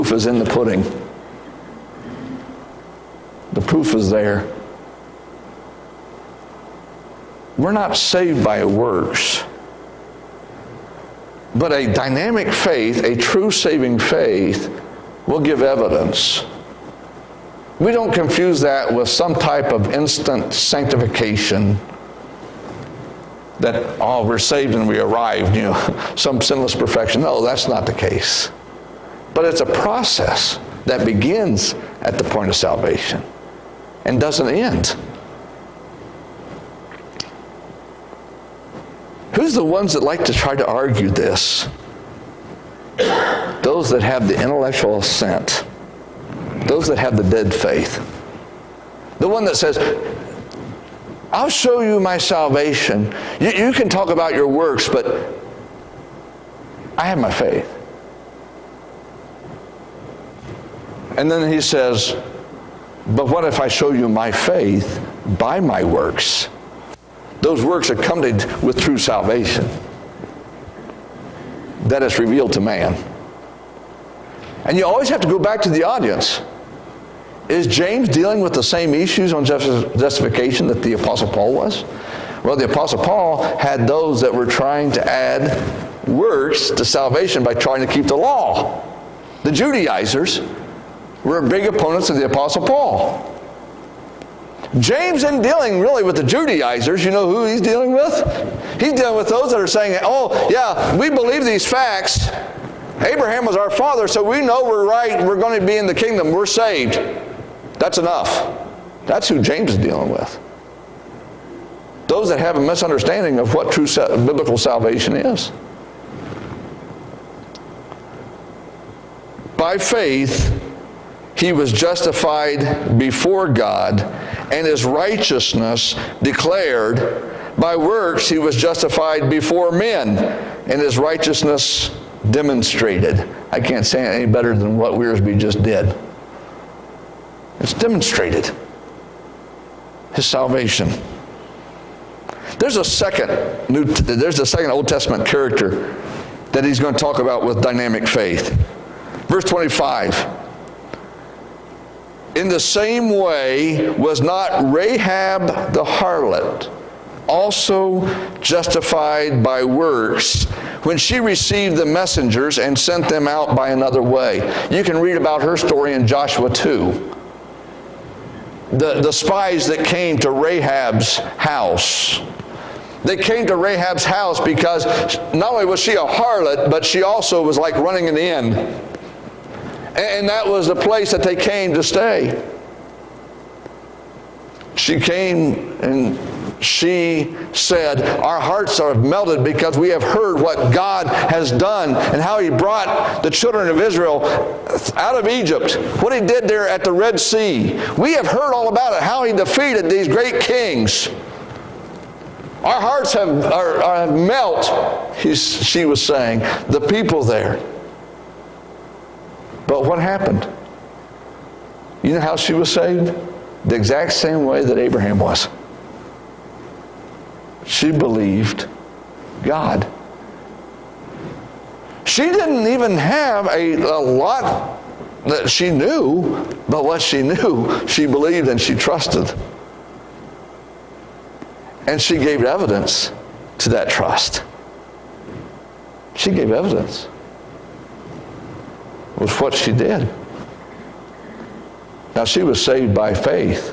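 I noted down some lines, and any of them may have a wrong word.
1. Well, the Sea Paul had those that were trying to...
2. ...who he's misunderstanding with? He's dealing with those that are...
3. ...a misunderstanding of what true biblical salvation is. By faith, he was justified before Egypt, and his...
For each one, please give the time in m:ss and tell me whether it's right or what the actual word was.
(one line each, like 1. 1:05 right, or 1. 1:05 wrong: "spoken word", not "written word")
1. 1:22 wrong: "Apostle", not "Sea"
2. 1:37 wrong: "dealing", not "misunderstanding"
3. 1:52 wrong: "God", not "Egypt".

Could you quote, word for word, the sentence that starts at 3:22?
Our hearts have are, are melt, she was saying, the people there.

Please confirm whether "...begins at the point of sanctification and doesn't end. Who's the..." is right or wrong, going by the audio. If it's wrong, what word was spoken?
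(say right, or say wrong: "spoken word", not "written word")
wrong: "salvation", not "sanctification".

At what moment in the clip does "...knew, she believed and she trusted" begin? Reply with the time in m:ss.
3:47.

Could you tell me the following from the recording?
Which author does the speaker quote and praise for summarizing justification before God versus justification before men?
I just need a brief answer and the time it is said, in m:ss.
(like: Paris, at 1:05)
Wiersbe, at 2:14.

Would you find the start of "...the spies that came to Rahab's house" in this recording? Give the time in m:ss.
2:49.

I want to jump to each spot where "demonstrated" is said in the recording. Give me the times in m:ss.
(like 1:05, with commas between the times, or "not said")
2:12, 2:17.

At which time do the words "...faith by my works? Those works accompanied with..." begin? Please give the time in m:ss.
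1:04.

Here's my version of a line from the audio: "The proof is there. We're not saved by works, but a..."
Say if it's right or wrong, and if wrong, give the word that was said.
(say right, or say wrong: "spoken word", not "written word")
right.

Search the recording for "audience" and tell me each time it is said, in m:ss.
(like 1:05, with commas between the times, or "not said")
1:15.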